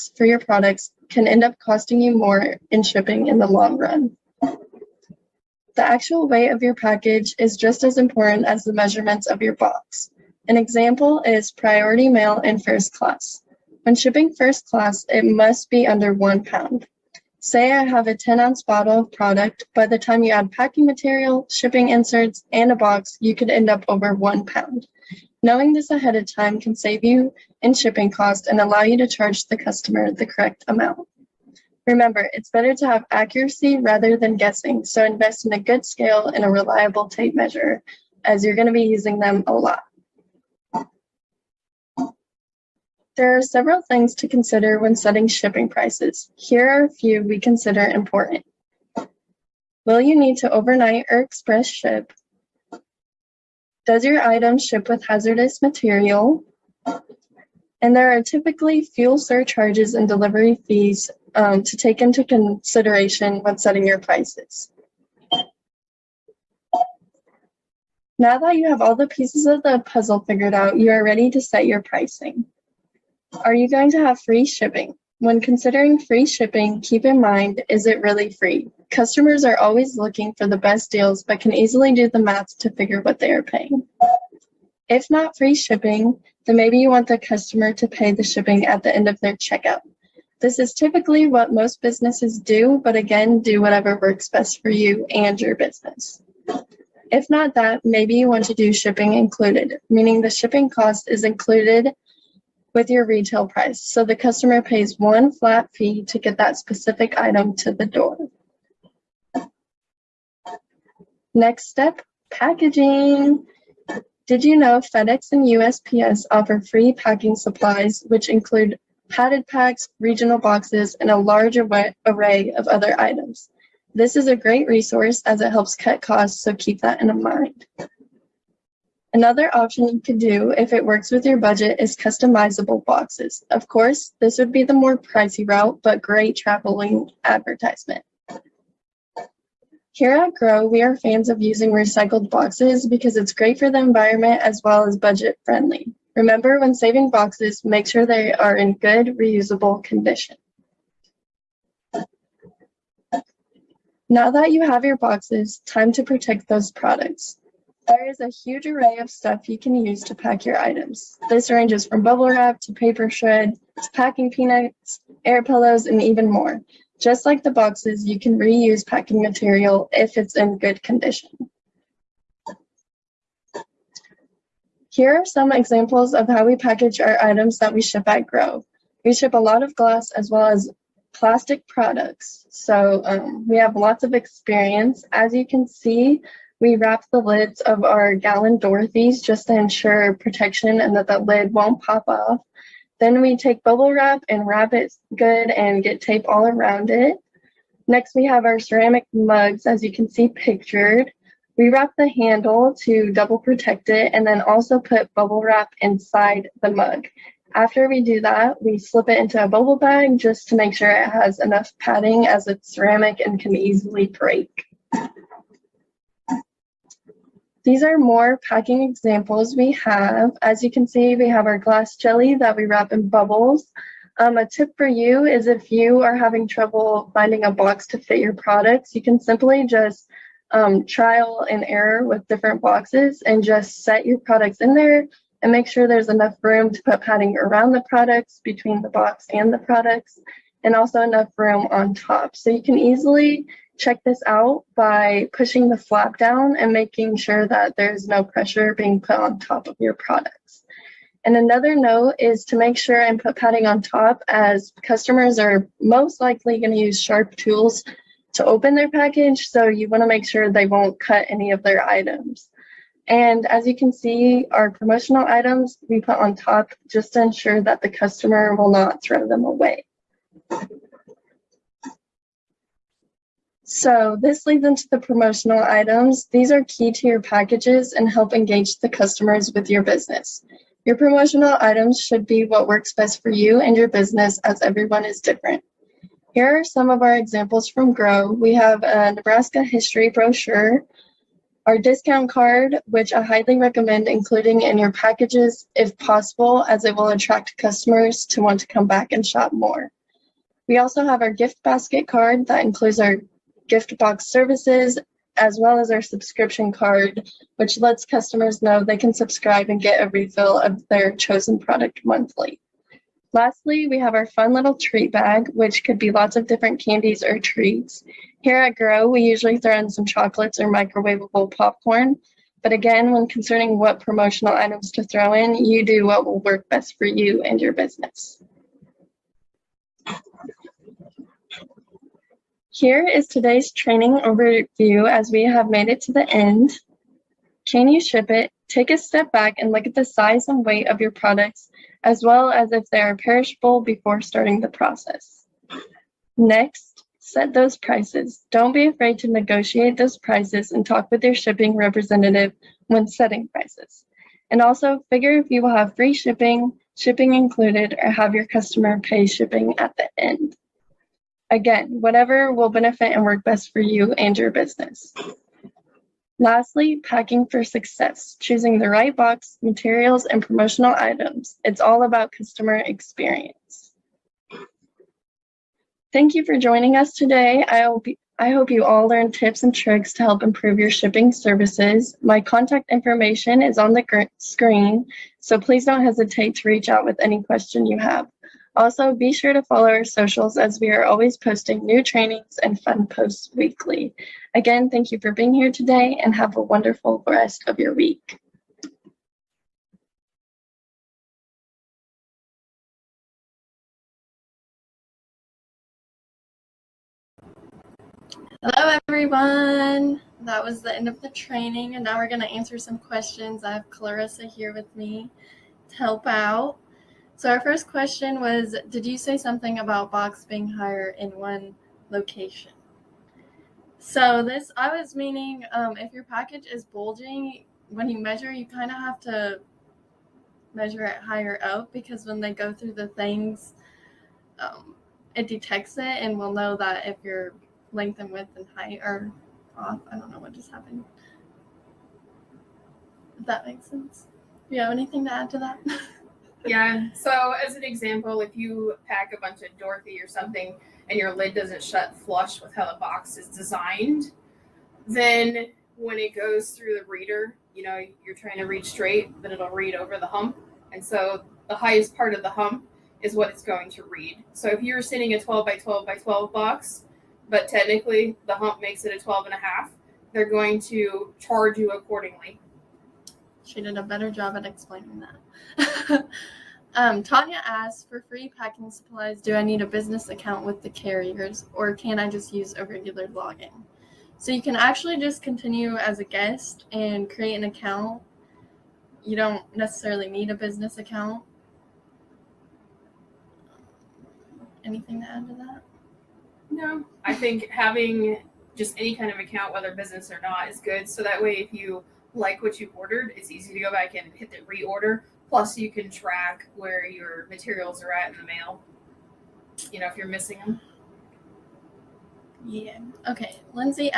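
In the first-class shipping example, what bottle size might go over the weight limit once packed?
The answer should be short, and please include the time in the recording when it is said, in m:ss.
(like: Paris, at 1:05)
10 ounce, at 0:18.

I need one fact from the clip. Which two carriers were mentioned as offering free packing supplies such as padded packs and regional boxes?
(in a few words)
FedEx and USPS.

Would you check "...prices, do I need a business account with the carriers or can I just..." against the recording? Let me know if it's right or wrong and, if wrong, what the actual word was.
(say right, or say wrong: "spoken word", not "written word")
wrong: "supplies", not "prices".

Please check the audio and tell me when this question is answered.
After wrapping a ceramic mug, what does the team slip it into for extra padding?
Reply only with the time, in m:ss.
3:29.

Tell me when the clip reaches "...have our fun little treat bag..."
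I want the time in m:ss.
5:13.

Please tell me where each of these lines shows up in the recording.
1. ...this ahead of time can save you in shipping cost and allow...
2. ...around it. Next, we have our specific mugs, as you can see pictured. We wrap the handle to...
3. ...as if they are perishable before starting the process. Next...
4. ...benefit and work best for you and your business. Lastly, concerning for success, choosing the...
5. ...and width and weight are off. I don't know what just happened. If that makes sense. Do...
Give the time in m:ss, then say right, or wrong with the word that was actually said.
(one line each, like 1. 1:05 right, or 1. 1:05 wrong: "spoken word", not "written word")
1. 0:25 right
2. 3:16 wrong: "ceramic", not "specific"
3. 5:42 right
4. 6:02 wrong: "packing", not "concerning"
5. 7:18 wrong: "height", not "weight".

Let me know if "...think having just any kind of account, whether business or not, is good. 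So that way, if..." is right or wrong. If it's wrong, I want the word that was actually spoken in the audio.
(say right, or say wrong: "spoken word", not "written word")
right.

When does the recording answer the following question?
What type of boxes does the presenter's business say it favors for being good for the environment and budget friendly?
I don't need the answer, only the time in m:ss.
2:21.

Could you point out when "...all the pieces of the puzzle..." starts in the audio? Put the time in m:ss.
1:08.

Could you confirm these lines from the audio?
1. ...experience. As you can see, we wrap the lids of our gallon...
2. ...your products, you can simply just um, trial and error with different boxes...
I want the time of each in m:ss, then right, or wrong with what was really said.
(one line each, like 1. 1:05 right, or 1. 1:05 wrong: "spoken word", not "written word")
1. 3:04 right
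2. 3:48 right.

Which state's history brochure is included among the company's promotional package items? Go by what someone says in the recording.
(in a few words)
Nebraska.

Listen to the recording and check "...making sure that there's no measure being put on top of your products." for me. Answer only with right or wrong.
wrong.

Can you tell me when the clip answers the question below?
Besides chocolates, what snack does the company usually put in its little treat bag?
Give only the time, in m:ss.
5:20.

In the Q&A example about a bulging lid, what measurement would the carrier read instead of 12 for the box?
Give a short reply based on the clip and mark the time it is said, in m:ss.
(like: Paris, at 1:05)
12 and a half, at 7:49.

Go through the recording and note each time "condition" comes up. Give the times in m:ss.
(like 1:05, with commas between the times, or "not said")
2:29, 2:50.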